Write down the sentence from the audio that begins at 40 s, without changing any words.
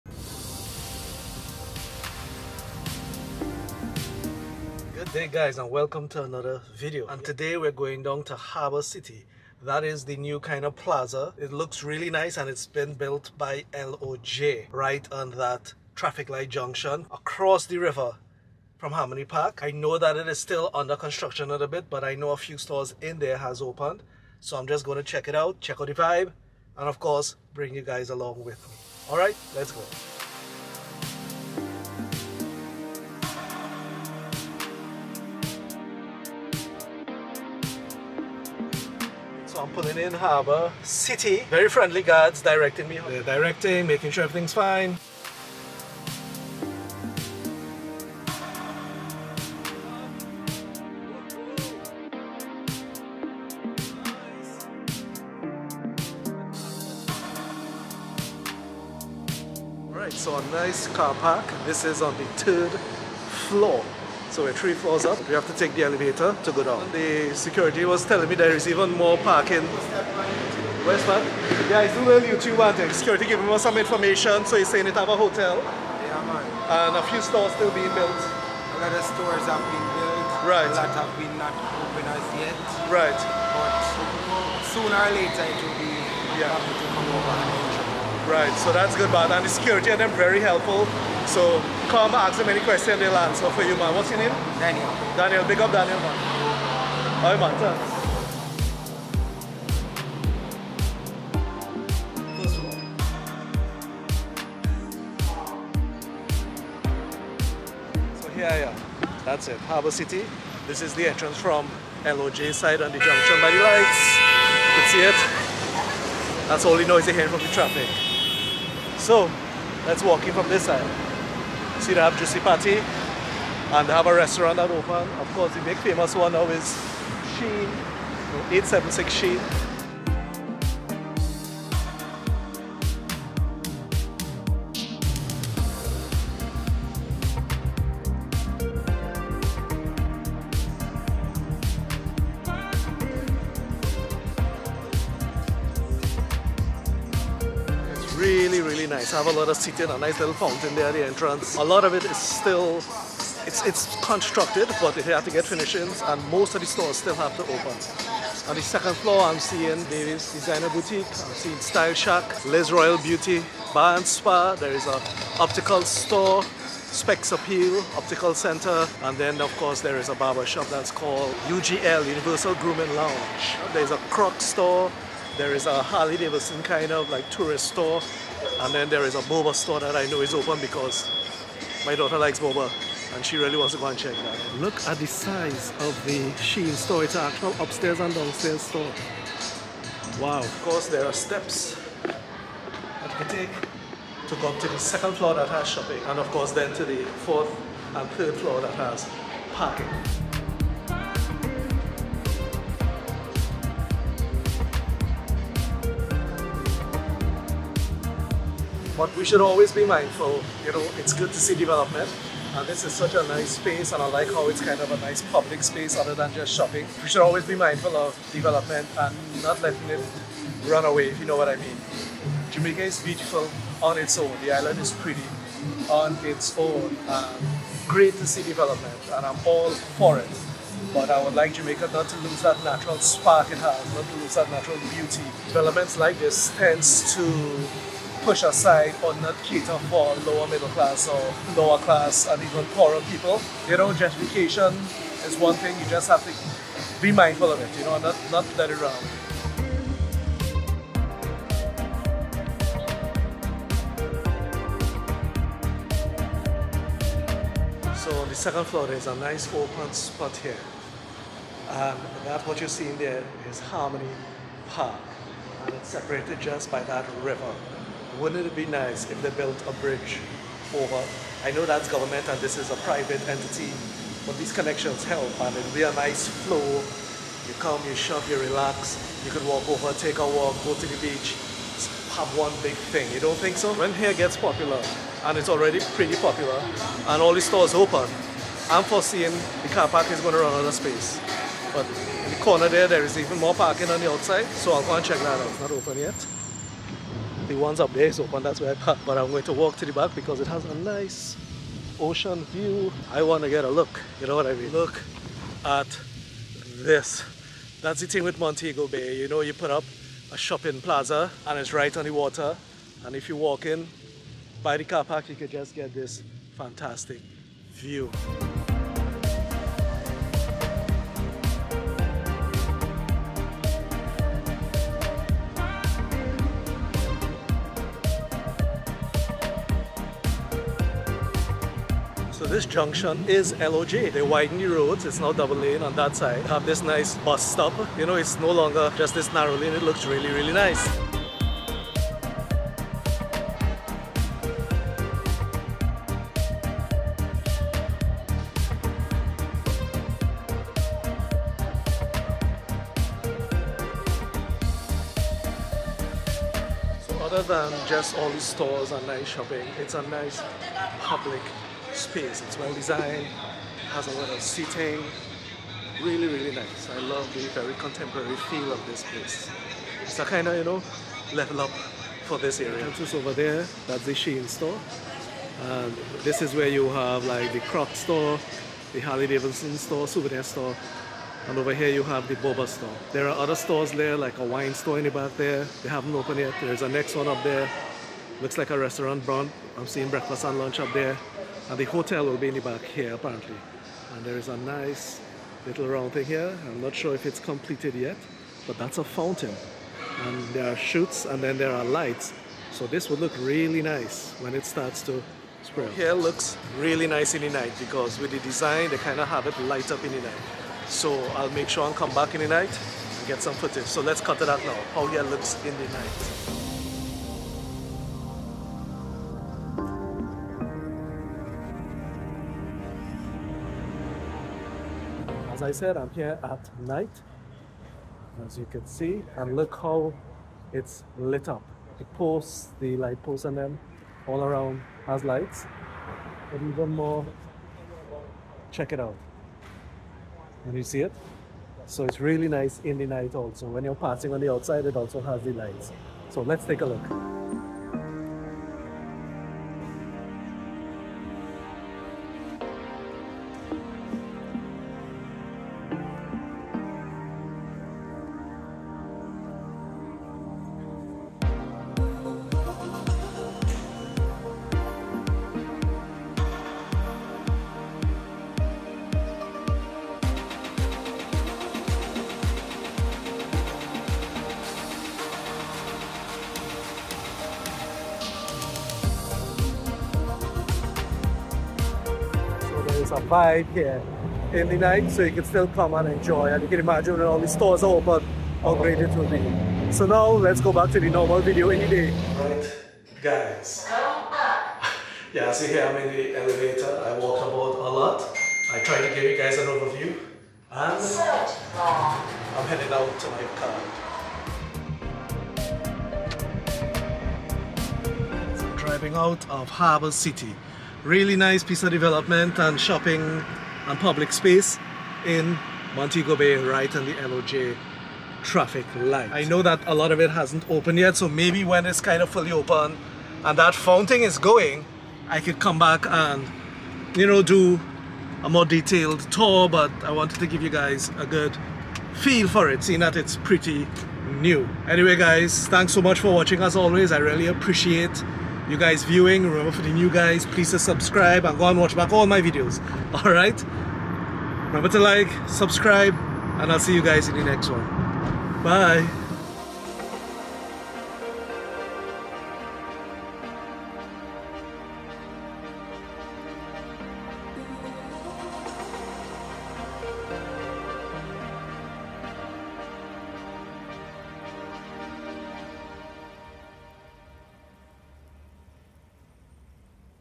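City, very friendly guards directing me.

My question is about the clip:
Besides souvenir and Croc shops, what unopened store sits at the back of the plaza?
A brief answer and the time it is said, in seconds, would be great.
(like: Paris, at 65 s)
Wine store, at 384 s.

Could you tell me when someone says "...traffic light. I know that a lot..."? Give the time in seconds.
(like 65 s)
518 s.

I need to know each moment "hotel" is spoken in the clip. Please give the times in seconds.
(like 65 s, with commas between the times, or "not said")
75 s, 391 s.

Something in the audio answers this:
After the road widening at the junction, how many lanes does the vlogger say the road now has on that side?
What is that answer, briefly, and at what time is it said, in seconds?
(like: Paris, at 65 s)
2, at 335 s.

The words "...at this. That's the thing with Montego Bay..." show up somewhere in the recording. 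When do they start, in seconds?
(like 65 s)
305 s.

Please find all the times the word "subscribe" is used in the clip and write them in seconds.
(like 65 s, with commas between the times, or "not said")
540 s, 545 s.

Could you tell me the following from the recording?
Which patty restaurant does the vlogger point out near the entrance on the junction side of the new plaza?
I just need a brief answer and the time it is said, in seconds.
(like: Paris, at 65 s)
Juicy Patty, at 122 s.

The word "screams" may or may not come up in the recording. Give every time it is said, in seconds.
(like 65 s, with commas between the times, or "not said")
not said.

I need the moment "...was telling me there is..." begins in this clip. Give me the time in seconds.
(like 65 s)
67 s.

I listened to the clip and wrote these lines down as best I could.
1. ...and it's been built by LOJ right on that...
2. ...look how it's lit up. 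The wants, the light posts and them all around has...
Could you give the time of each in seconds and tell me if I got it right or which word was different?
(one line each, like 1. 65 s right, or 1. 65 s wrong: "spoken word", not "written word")
1. 12 s right
2. 429 s wrong: "posts", not "wants".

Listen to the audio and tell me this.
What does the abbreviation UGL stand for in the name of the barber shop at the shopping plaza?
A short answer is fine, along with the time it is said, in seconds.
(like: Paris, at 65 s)
Universal Grooming Lounge, at 172 s.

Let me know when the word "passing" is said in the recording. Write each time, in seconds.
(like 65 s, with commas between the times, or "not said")
443 s.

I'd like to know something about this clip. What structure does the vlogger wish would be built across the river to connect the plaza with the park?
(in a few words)
A bridge.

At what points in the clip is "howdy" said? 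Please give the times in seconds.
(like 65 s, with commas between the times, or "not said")
not said.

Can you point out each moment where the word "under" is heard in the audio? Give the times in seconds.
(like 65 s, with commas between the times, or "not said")
20 s.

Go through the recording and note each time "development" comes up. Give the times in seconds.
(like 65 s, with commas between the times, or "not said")
211 s, 218 s, 228 s, 235 s, 511 s.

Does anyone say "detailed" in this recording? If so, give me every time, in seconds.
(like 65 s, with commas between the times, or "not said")
528 s.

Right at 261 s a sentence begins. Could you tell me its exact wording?
And that what you're seeing there is Harmony Park.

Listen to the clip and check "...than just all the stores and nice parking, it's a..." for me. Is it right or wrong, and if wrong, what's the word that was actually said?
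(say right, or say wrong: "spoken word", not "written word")
wrong: "shopping", not "parking".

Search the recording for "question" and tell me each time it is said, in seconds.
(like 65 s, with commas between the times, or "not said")
92 s.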